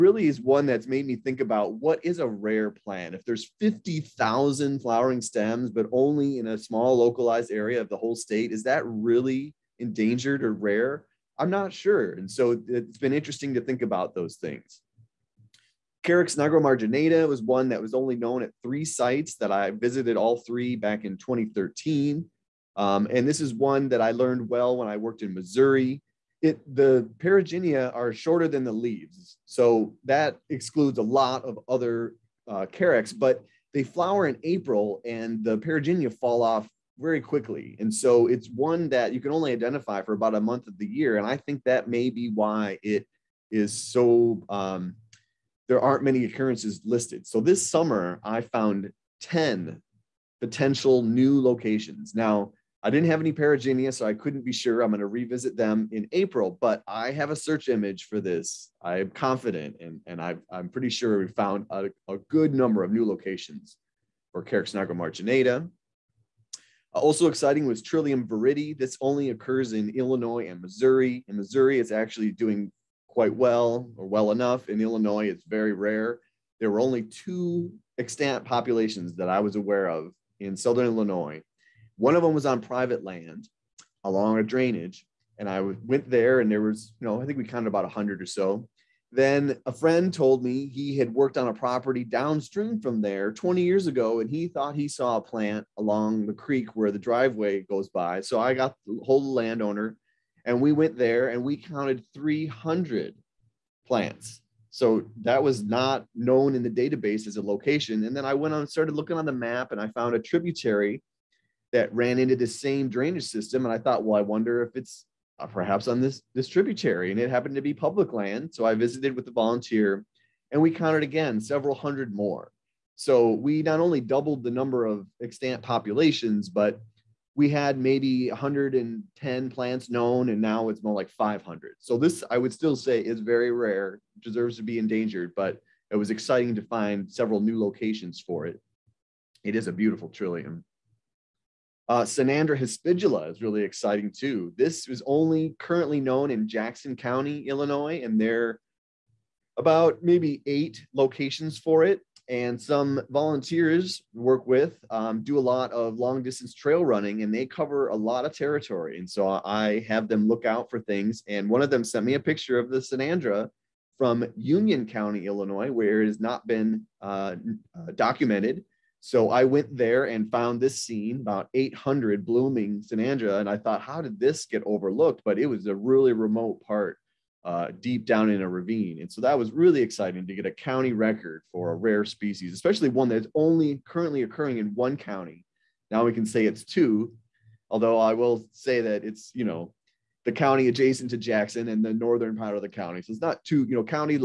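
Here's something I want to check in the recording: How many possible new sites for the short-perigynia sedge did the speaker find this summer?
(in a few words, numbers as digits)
10.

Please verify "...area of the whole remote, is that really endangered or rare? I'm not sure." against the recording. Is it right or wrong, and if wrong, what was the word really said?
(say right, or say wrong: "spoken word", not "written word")
wrong: "state", not "remote".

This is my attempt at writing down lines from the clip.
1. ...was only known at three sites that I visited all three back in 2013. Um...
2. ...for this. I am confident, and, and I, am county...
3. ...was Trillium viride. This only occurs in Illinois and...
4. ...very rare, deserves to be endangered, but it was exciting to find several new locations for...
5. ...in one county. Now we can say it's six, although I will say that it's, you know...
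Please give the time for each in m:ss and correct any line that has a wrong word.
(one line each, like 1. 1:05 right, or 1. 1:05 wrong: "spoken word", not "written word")
1. 0:17 right
2. 0:58 wrong: "pretty", not "county"
3. 1:07 right
4. 2:13 right
5. 3:04 wrong: "two", not "six".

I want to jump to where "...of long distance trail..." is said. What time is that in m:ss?
2:35.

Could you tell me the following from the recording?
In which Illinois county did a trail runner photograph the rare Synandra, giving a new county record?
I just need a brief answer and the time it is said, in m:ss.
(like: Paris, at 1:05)
Union County, at 2:44.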